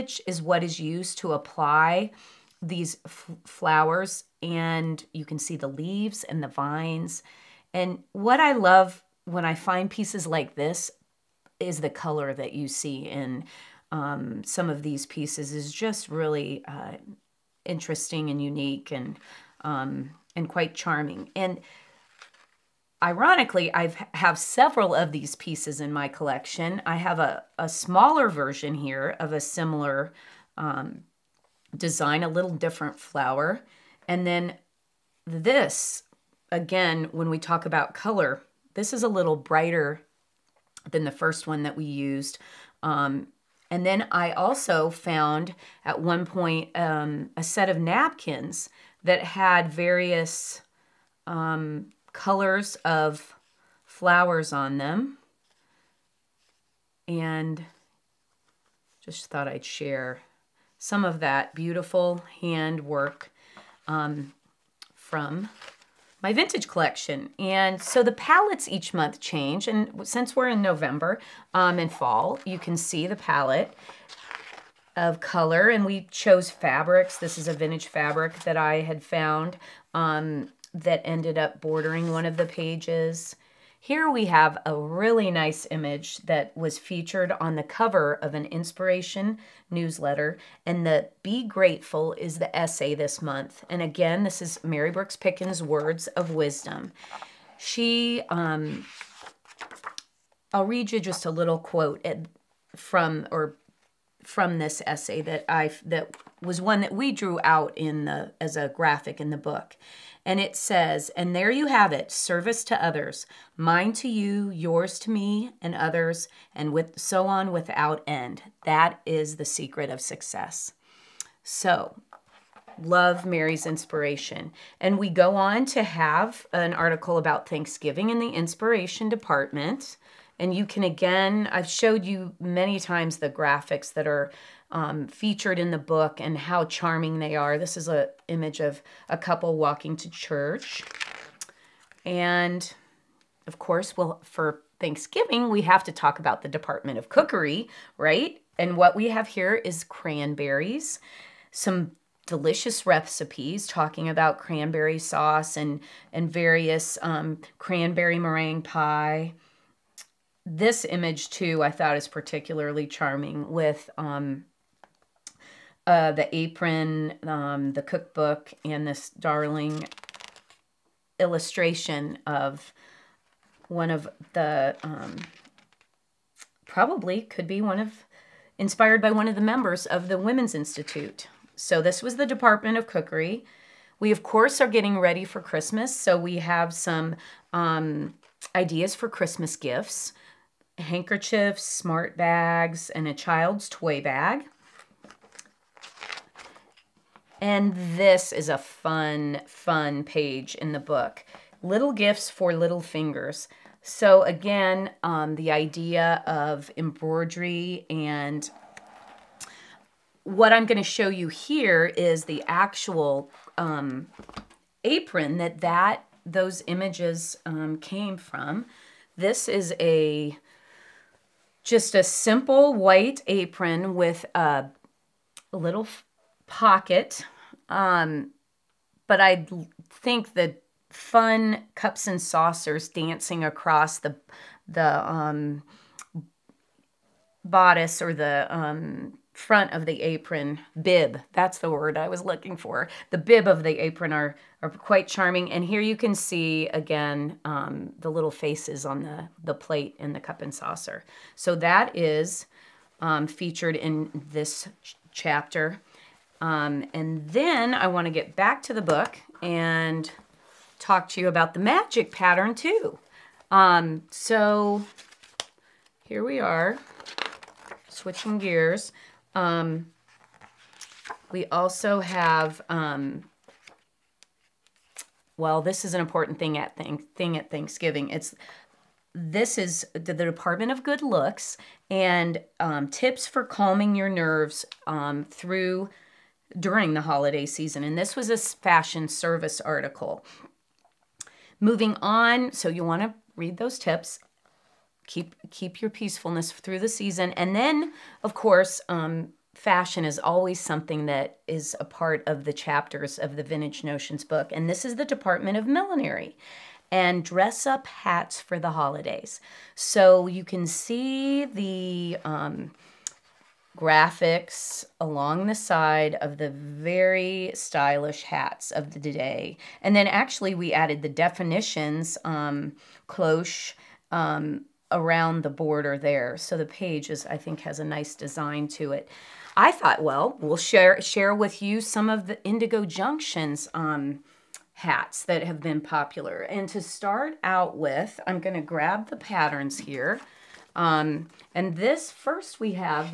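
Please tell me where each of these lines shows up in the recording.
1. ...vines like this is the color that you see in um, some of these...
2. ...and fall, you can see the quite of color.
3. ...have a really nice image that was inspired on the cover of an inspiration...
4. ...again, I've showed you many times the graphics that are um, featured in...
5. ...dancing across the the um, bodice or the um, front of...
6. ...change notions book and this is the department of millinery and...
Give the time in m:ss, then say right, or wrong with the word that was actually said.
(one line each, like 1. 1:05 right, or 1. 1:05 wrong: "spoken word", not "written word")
1. 0:09 wrong: "pieces", not "vines"
2. 1:11 wrong: "palette", not "quite"
3. 1:24 wrong: "featured", not "inspired"
4. 2:10 right
5. 3:52 right
6. 5:03 wrong: "vintage", not "change".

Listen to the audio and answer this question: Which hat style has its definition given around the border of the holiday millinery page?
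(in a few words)
Cloche.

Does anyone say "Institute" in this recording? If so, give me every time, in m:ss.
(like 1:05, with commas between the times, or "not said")
3:00.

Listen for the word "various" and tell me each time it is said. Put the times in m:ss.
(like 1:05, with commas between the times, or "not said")
0:49, 2:36.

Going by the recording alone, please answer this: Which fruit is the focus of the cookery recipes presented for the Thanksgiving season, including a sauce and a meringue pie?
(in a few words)
Cranberries.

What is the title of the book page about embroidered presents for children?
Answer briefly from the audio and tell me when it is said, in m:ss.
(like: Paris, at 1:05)
Little gifts for little fingers, at 3:21.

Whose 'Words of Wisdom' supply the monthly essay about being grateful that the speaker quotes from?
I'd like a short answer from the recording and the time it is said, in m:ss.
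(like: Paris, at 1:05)
Mary Brooks Picken, at 1:34.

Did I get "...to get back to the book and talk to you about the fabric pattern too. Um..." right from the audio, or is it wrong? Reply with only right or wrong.
wrong.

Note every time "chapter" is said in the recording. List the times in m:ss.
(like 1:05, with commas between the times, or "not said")
4:15, 5:02.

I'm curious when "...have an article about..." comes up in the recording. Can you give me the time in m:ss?
2:05.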